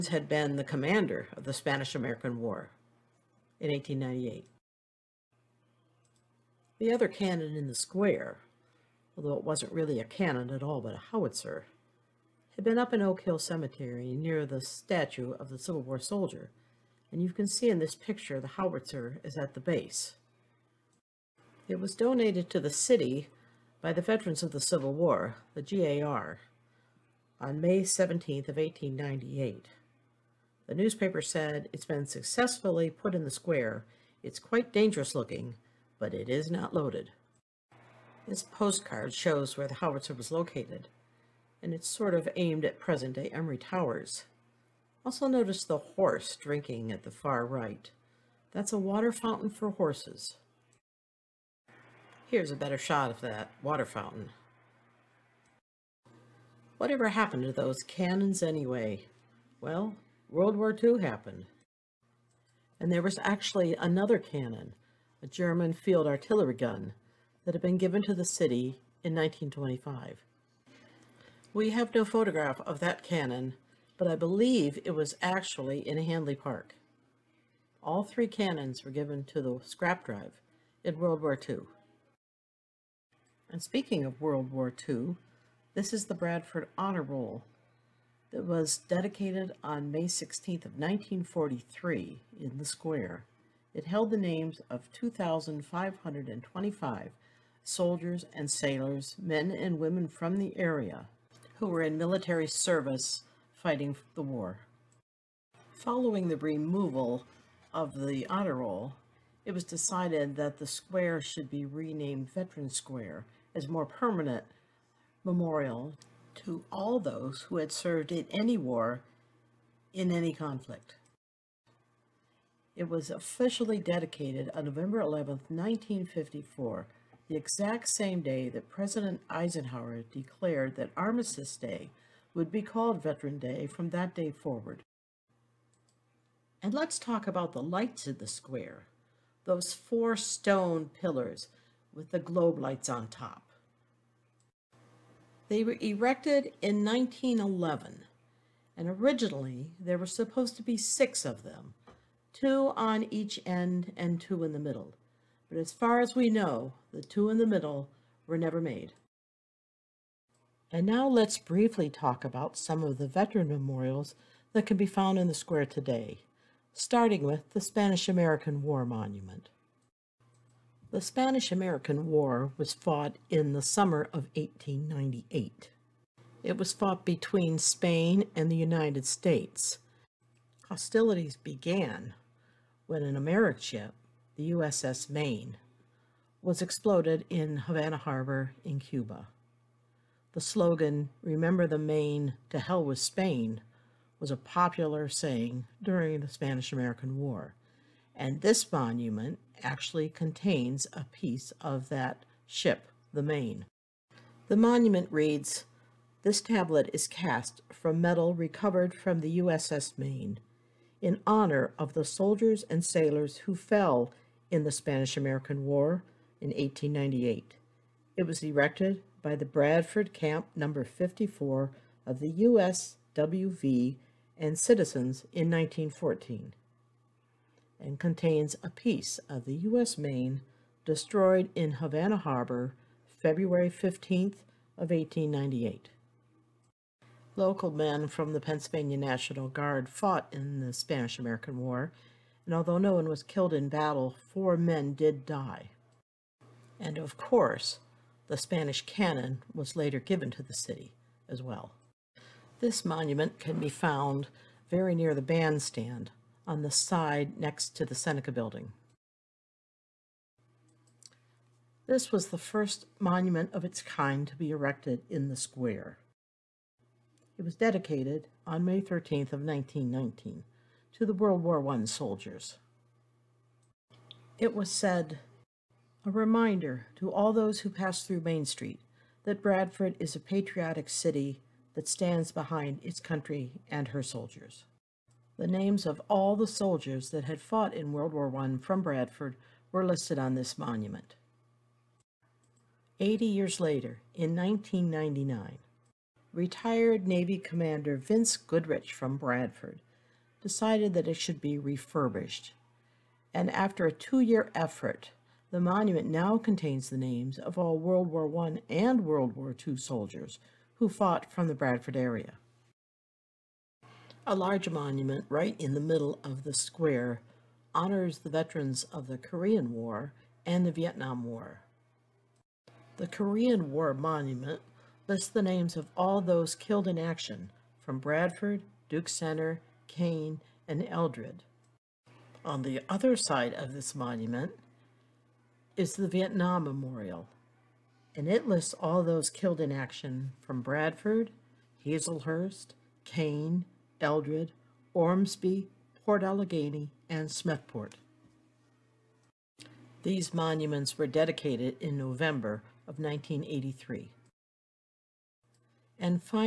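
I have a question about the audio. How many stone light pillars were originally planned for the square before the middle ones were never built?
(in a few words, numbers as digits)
6.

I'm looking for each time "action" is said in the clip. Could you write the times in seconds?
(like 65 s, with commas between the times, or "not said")
326 s, 339 s.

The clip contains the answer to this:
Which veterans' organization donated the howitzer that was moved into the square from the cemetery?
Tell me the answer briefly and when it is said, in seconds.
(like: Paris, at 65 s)
GAR, at 25 s.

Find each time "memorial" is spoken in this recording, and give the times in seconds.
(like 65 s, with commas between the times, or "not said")
115 s, 163 s, 336 s.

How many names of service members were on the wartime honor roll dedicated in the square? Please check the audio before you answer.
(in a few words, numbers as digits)
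2,525.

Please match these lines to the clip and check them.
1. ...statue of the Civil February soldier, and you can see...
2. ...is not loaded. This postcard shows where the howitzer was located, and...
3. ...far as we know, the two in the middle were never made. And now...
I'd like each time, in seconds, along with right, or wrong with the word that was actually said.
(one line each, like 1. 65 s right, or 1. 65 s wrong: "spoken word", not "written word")
1. 14 s wrong: "War", not "February"
2. 36 s right
3. 155 s right.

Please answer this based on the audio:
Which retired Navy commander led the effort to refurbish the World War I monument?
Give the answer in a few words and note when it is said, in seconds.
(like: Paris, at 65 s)
Vince Goodrich, at 297 s.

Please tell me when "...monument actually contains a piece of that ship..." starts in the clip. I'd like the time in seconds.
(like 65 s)
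198 s.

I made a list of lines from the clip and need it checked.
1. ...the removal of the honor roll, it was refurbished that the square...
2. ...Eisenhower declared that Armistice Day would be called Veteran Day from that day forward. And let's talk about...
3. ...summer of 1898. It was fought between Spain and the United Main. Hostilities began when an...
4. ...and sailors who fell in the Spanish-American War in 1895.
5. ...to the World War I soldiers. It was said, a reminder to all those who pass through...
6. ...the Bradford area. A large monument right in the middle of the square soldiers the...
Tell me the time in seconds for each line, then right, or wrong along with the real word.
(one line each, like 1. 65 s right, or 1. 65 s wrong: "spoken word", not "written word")
1. 106 s wrong: "decided", not "refurbished"
2. 129 s right
3. 173 s wrong: "States", not "Main"
4. 212 s wrong: "1898", not "1895"
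5. 270 s right
6. 311 s wrong: "honors", not "soldiers".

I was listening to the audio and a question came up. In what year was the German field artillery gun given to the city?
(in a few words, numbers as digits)
1925.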